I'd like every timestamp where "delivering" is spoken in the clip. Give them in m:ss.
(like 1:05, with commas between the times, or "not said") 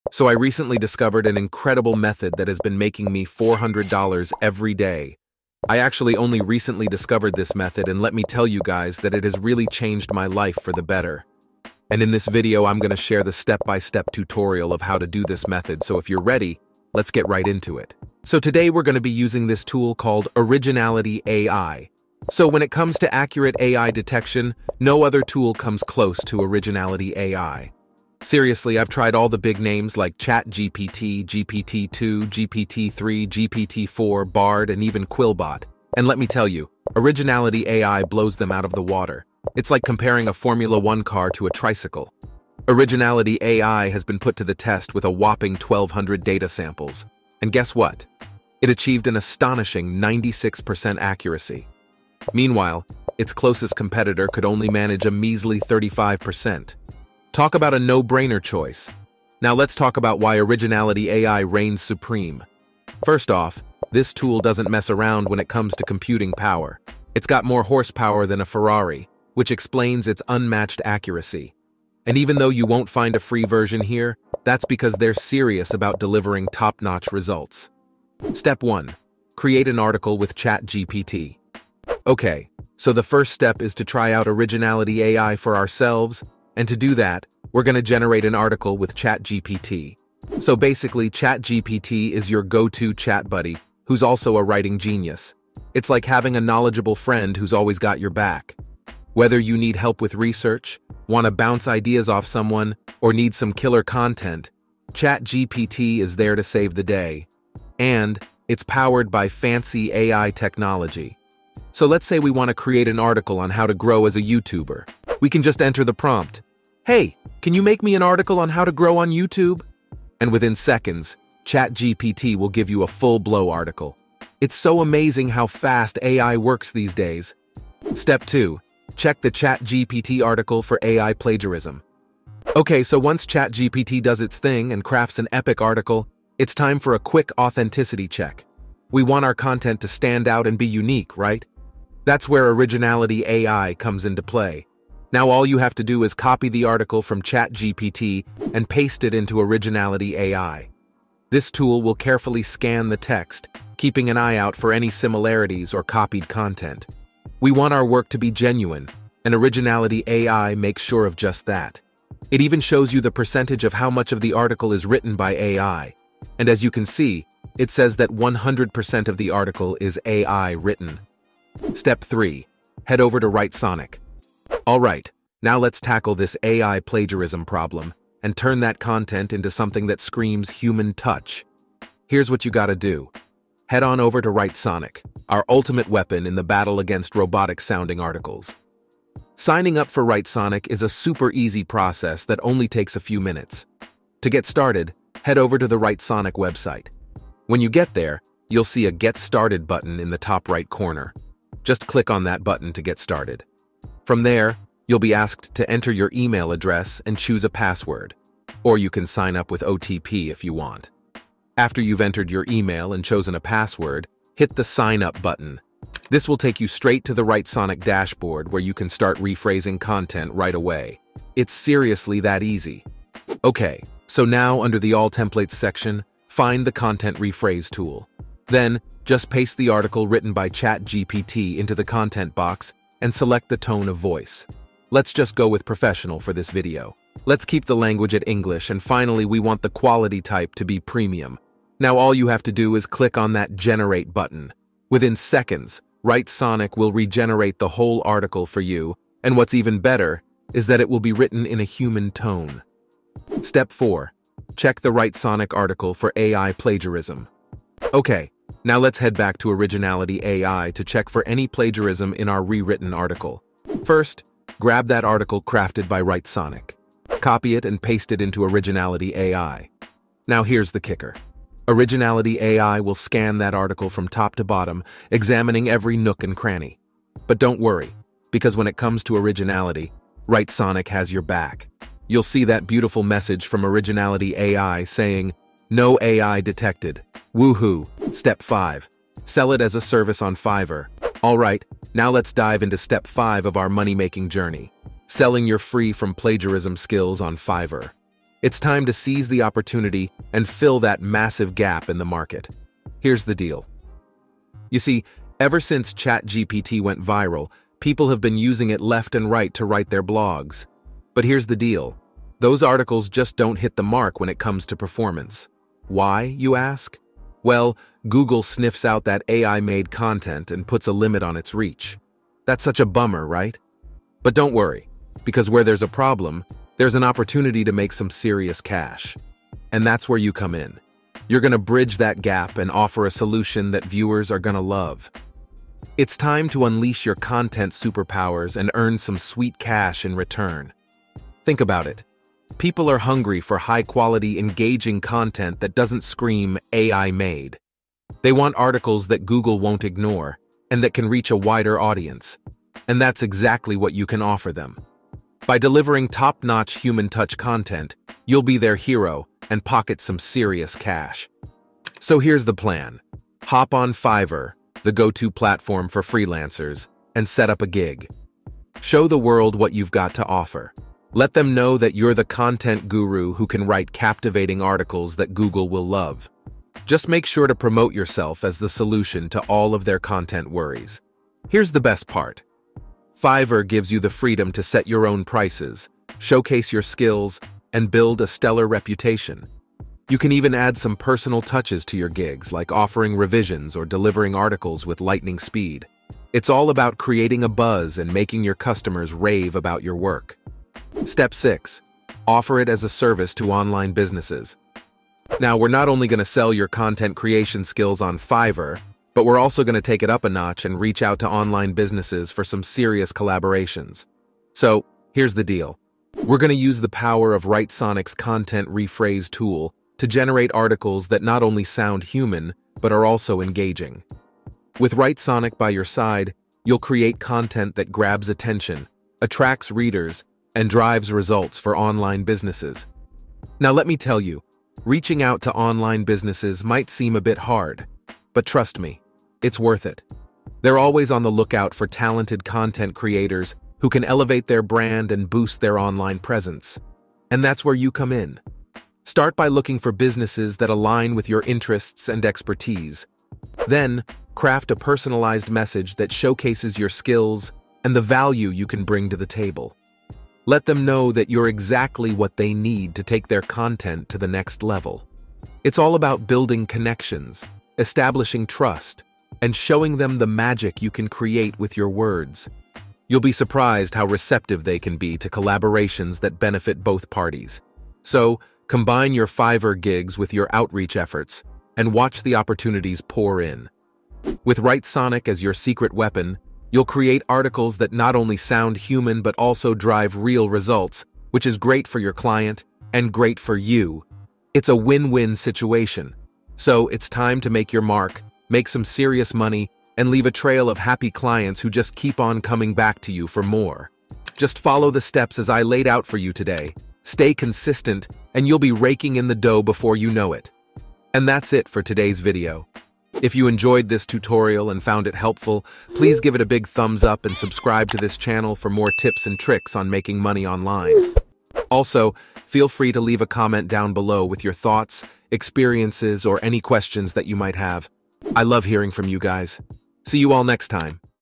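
1:16, 5:55, 6:33.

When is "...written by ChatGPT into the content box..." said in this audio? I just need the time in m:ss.
3:50.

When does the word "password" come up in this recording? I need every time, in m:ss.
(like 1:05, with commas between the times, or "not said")
3:27, 3:33.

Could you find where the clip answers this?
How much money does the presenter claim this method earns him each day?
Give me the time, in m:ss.
0:03.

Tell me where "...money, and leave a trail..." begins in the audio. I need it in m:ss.
8:19.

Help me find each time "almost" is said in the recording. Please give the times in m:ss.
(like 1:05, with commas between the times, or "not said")
not said.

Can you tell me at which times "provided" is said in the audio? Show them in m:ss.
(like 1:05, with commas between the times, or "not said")
not said.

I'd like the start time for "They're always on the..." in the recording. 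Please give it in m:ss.
7:20.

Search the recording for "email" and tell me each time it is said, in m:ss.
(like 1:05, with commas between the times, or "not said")
3:26, 3:32.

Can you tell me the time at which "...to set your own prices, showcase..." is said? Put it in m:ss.
6:24.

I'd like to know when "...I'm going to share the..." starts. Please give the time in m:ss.
0:12.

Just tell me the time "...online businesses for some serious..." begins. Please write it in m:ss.
6:51.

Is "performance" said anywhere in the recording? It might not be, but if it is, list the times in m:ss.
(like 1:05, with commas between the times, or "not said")
5:14.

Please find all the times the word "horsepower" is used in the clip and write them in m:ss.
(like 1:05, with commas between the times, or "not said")
1:07.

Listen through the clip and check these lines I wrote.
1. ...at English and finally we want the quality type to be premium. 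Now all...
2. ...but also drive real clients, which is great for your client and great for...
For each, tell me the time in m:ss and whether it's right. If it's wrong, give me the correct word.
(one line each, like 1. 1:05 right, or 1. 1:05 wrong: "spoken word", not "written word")
1. 3:58 right
2. 8:09 wrong: "results", not "clients".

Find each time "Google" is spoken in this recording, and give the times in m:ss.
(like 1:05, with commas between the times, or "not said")
5:18, 5:49, 6:15.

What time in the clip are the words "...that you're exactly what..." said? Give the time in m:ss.
7:41.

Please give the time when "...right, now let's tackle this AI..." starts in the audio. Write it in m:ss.
2:54.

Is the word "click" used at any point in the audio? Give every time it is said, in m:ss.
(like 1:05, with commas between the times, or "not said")
3:21, 4:02.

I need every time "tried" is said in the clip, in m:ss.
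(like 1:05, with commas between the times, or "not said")
0:28.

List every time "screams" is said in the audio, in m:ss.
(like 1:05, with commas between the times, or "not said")
3:00, 5:46.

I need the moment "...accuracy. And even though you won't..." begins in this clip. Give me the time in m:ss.
1:10.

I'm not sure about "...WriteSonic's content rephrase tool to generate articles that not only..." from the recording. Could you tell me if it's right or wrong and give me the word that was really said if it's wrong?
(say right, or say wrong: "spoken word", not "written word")
right.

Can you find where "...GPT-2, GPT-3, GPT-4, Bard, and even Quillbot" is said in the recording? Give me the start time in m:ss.
0:31.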